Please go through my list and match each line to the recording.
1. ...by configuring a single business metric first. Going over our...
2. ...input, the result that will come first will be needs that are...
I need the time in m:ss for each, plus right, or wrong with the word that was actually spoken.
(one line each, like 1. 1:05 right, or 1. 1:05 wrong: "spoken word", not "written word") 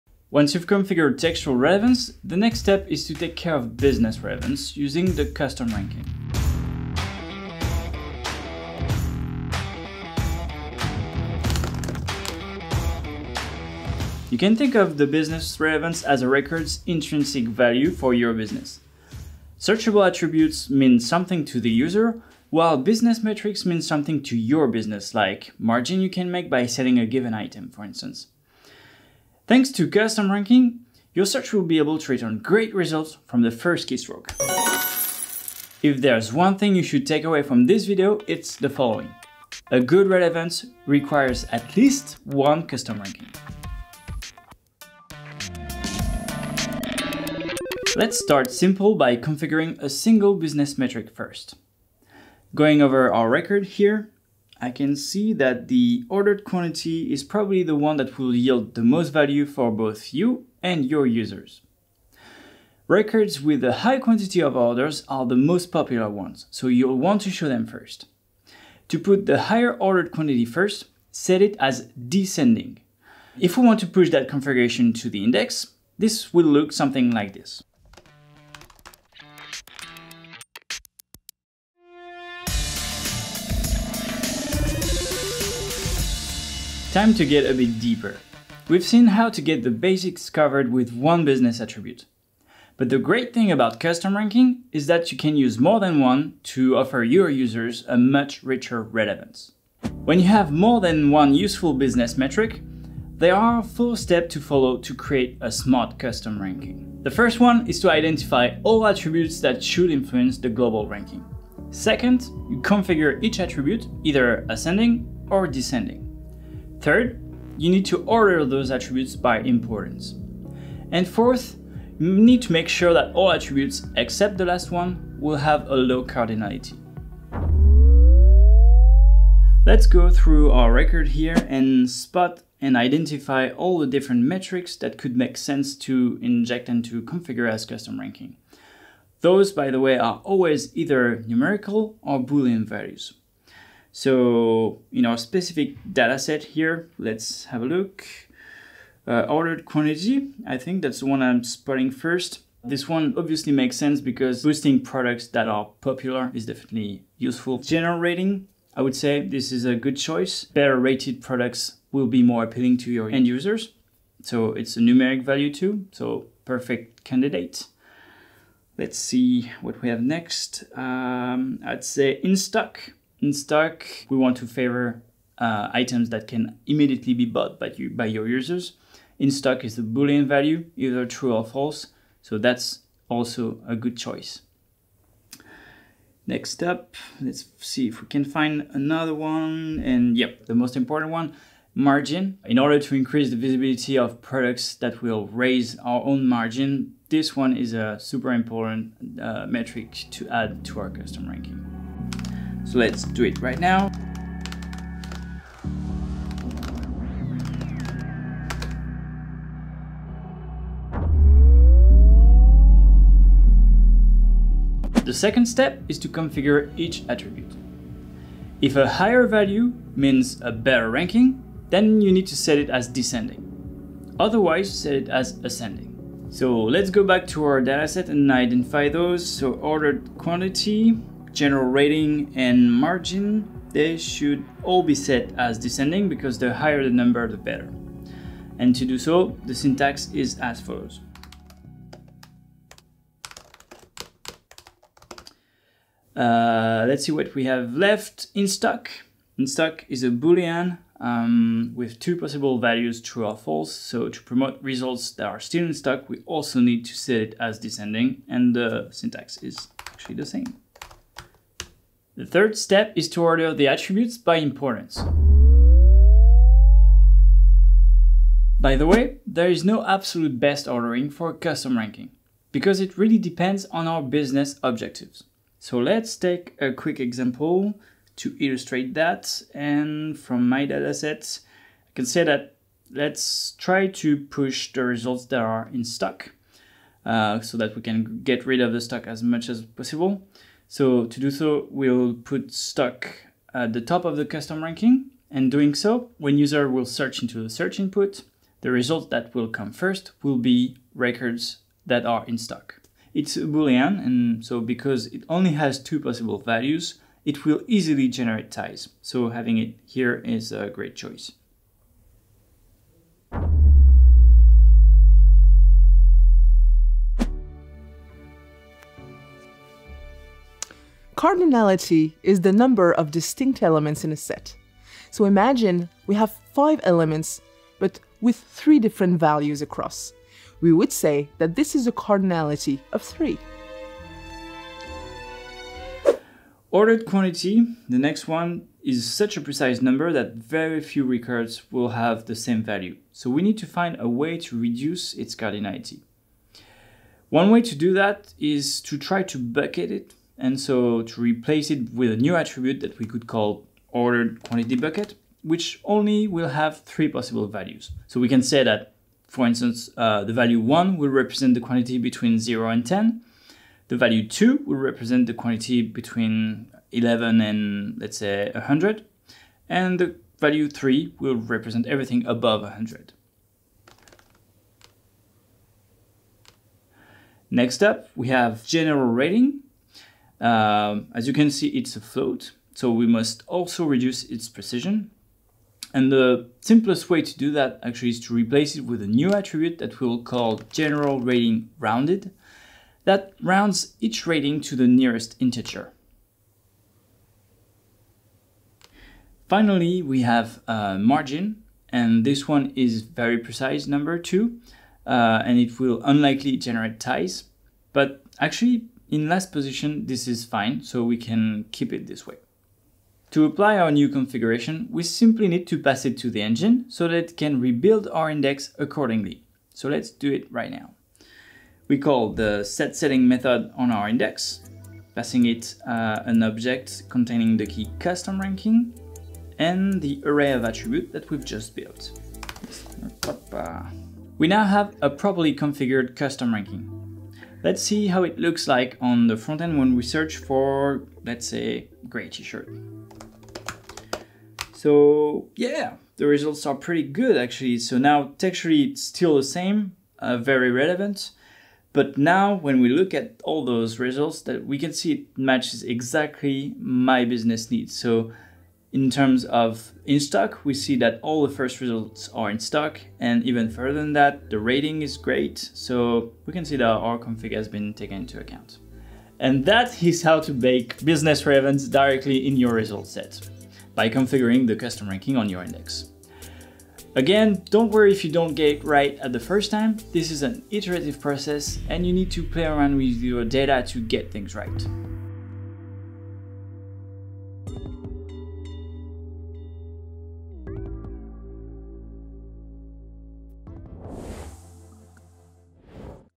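1. 0:48 right
2. 4:57 wrong: "records", not "needs".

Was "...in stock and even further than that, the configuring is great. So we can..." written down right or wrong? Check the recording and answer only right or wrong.
wrong.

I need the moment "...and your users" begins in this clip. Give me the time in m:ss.
1:00.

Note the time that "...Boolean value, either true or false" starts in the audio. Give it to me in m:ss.
2:59.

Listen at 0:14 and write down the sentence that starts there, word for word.
You can think of the business relevance as a record's intrinsic value for your business.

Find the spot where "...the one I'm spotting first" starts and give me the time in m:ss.
2:30.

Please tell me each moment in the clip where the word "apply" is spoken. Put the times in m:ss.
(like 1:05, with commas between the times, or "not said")
6:53.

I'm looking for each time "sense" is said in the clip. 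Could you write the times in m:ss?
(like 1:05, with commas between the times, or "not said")
2:15, 2:33.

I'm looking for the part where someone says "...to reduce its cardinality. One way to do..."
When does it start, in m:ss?
5:44.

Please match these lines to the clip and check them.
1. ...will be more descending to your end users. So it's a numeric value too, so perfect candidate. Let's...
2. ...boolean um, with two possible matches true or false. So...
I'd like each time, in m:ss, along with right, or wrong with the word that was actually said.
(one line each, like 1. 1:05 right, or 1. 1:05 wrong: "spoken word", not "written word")
1. 2:41 wrong: "appealing", not "descending"
2. 4:10 wrong: "values", not "matches".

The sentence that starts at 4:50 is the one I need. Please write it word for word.
So to do so, we'll put stock at the top of the custom ranking.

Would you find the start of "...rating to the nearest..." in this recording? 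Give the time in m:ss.
6:34.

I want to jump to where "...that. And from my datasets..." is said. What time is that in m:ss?
4:38.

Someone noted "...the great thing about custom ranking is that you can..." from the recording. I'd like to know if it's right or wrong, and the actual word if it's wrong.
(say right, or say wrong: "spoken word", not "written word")
right.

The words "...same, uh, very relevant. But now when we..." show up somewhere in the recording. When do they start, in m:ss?
7:29.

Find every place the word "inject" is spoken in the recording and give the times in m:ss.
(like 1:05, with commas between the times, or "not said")
2:16.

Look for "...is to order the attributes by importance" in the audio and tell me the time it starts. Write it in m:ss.
4:22.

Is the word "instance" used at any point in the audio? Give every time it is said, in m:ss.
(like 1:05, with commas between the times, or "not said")
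0:27, 5:59.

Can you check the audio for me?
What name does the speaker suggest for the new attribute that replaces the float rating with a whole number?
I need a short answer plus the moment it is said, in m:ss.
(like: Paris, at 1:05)
general rating rounded, at 6:30.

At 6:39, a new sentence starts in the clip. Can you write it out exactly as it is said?
Finally, we have a margin, and this one is very precise, number two, uh, and it will unlikely generate ties.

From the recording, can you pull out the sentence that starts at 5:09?
So having it here is a great choice.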